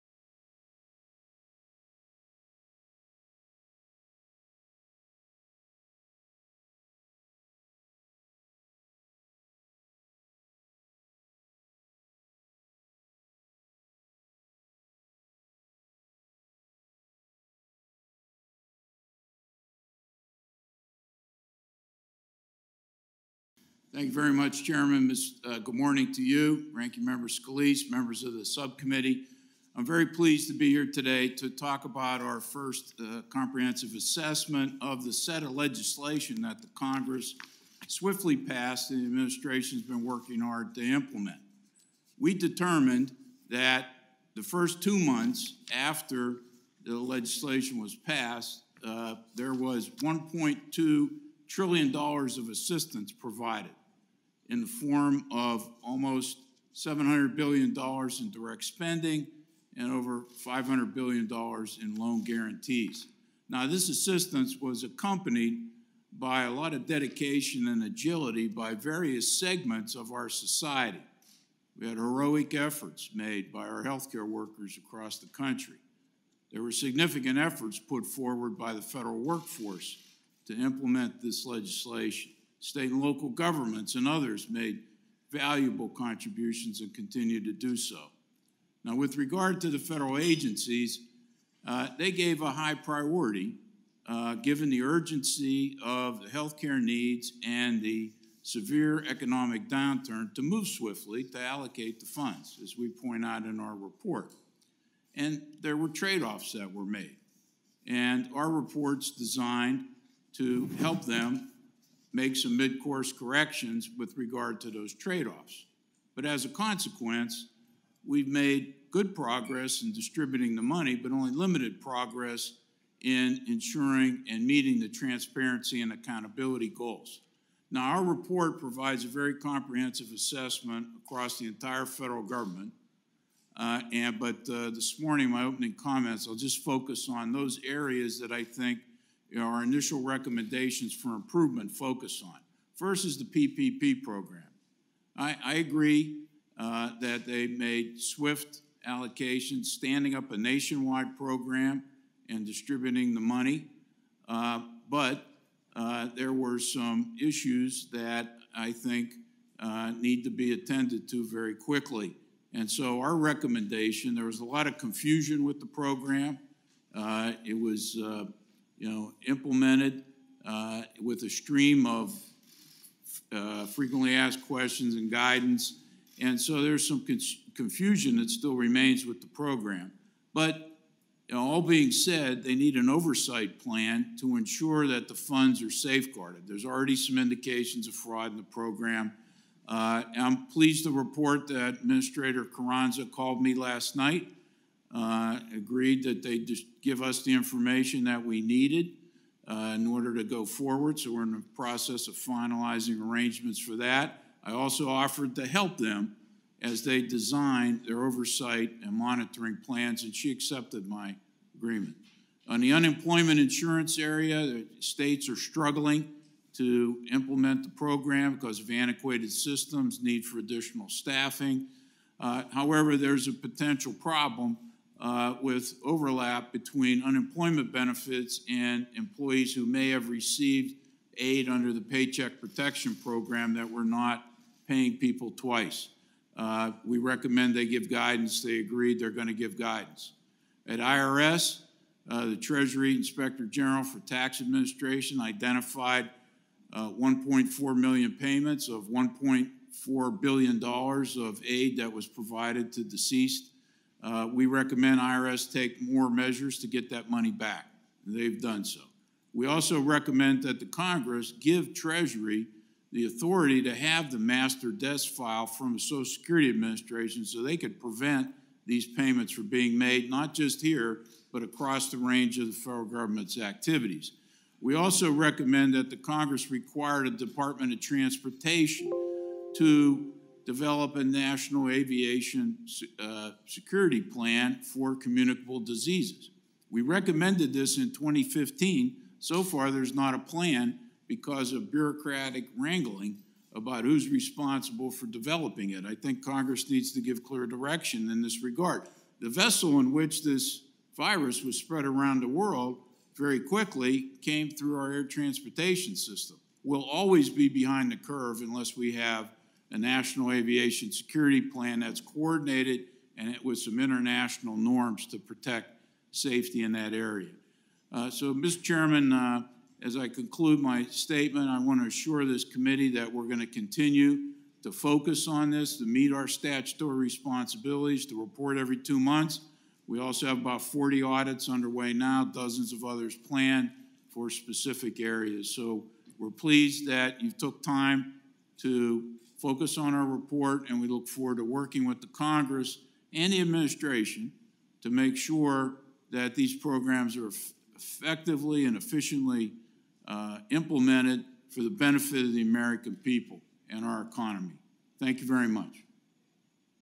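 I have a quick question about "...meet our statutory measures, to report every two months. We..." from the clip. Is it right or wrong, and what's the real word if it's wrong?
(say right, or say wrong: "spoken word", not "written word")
wrong: "responsibilities", not "measures".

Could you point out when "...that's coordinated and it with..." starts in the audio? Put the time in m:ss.
5:11.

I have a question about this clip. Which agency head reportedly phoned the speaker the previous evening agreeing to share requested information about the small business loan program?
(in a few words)
Administrator Carranza.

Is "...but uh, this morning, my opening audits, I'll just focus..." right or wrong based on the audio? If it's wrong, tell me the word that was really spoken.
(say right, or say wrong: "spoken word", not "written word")
wrong: "comments", not "audits".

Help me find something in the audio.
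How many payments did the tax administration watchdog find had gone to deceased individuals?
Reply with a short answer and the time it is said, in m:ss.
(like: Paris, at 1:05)
1.4 million, at 4:06.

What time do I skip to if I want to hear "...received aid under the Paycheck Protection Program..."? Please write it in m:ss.
3:50.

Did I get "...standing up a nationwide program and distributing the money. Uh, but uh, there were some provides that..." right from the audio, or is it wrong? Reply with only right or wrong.
wrong.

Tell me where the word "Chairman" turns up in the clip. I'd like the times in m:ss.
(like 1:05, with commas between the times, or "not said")
0:24, 5:18.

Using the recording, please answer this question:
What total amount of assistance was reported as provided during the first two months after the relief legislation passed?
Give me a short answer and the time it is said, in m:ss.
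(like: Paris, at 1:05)
$1.2 trillion, at 0:50.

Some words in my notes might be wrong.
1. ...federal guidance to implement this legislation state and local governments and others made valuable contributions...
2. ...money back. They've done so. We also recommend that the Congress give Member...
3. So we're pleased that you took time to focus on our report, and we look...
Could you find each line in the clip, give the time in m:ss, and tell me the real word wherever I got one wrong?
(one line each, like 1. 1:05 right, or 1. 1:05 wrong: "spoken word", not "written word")
1. 1:18 wrong: "workforce", not "guidance"
2. 4:17 wrong: "Treasury", not "Member"
3. 5:35 right.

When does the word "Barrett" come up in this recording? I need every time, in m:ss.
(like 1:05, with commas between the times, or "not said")
not said.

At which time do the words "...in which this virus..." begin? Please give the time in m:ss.
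4:59.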